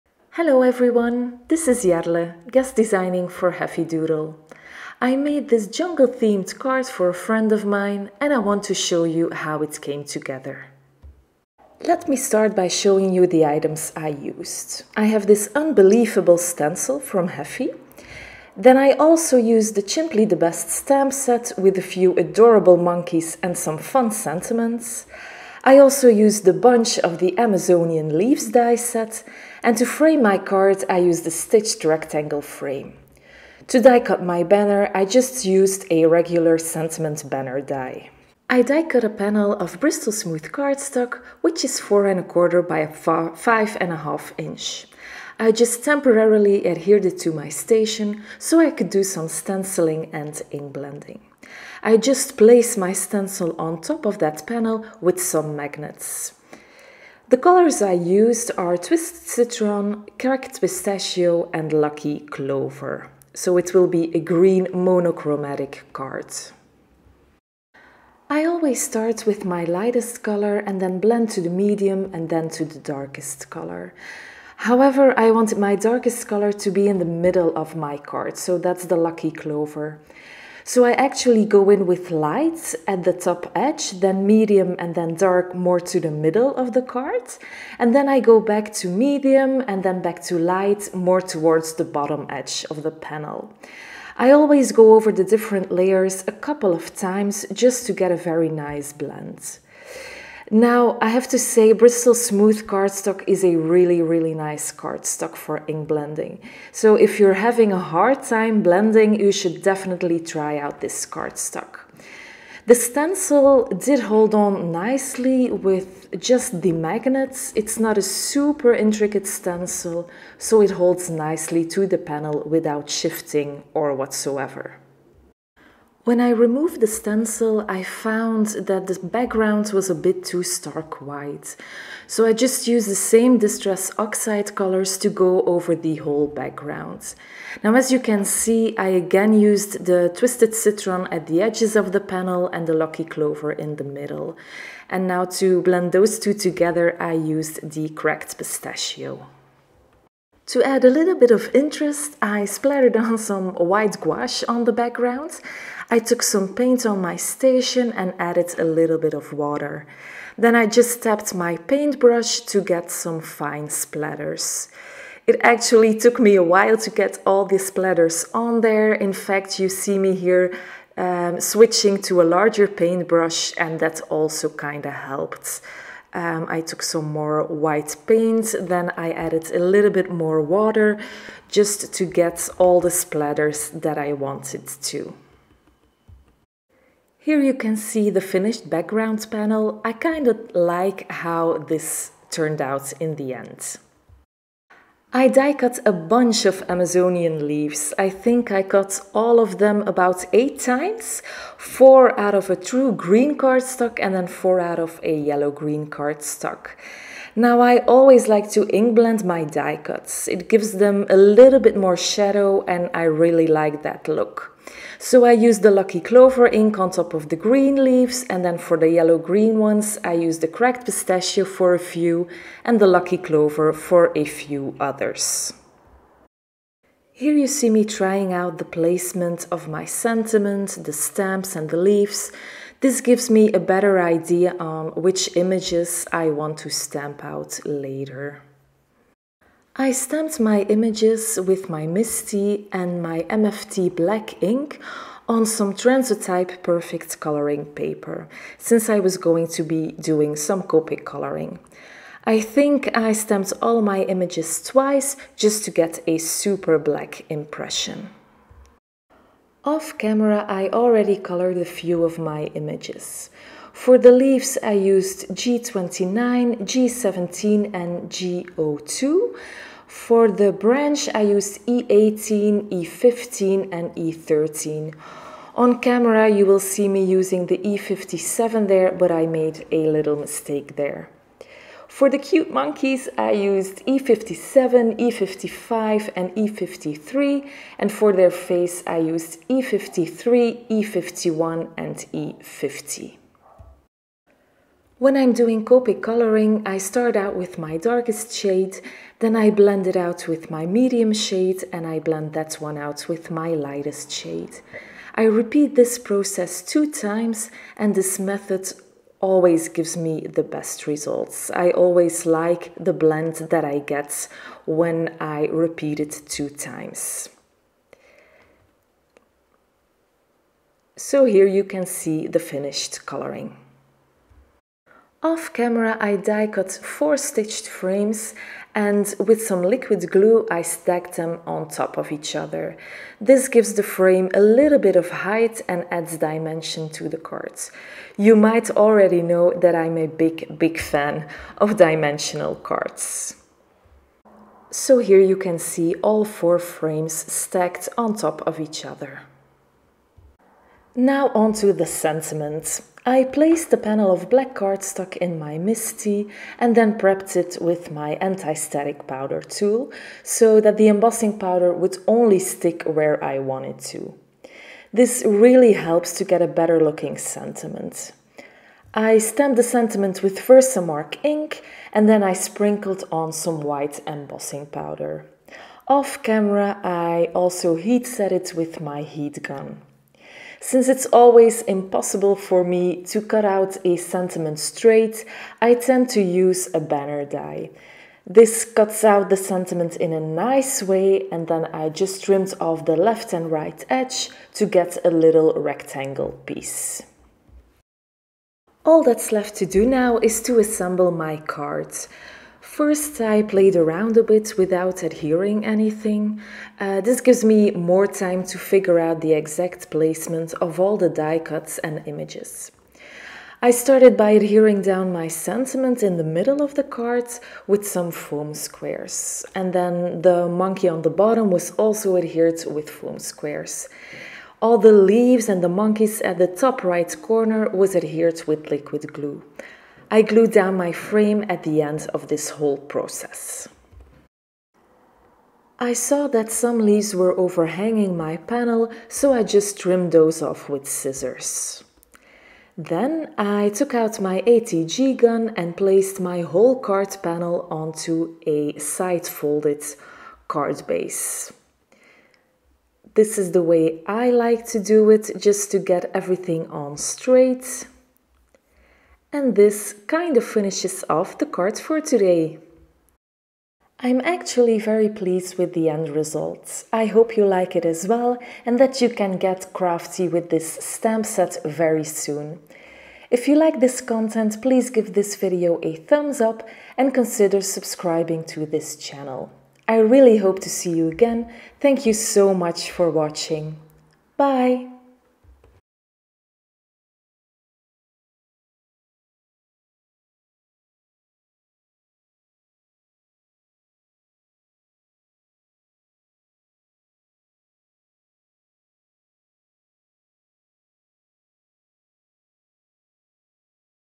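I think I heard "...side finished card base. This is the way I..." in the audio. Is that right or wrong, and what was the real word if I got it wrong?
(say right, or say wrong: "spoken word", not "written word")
wrong: "folded", not "finished".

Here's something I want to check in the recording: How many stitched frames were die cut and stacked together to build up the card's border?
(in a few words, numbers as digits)
4.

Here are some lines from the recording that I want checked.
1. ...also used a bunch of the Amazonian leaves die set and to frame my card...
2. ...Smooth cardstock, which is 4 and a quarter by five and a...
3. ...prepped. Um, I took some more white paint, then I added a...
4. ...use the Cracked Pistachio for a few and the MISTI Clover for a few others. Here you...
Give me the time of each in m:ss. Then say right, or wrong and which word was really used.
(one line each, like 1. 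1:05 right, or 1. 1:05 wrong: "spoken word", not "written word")
1. 0:25 right
2. 0:40 right
3. 2:54 wrong: "helped", not "prepped"
4. 3:40 wrong: "Lucky", not "MISTI".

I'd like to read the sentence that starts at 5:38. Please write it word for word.
You might already know that I'm a big, big fan of dimensional cards.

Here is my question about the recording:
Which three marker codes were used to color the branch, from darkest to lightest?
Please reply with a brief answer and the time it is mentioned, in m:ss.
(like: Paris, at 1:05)
E18, E15, E13, at 4:31.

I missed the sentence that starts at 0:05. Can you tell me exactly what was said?
I made this jungle themed card for a friend of mine and I want to show you how it came together.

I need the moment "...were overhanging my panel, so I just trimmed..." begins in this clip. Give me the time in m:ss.
7:17.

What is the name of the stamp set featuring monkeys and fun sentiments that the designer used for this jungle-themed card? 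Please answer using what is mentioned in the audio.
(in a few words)
Chimply the Best.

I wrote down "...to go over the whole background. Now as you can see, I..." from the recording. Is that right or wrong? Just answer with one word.
right.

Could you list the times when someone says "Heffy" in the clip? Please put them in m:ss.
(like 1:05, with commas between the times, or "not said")
0:03, 0:17.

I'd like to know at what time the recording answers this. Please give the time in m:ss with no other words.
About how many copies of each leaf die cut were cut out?
3:20.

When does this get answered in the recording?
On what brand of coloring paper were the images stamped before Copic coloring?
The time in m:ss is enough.
4:05.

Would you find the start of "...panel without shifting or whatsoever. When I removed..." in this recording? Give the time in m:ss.
2:01.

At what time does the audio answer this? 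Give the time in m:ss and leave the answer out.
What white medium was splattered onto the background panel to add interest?
2:33.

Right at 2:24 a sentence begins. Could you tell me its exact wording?
And now to blend those two together, I used the Cracked Pistachio.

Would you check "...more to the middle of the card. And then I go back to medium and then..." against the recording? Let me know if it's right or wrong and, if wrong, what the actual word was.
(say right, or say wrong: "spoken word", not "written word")
right.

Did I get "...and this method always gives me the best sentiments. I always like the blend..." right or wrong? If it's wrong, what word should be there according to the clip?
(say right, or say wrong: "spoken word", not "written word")
wrong: "results", not "sentiments".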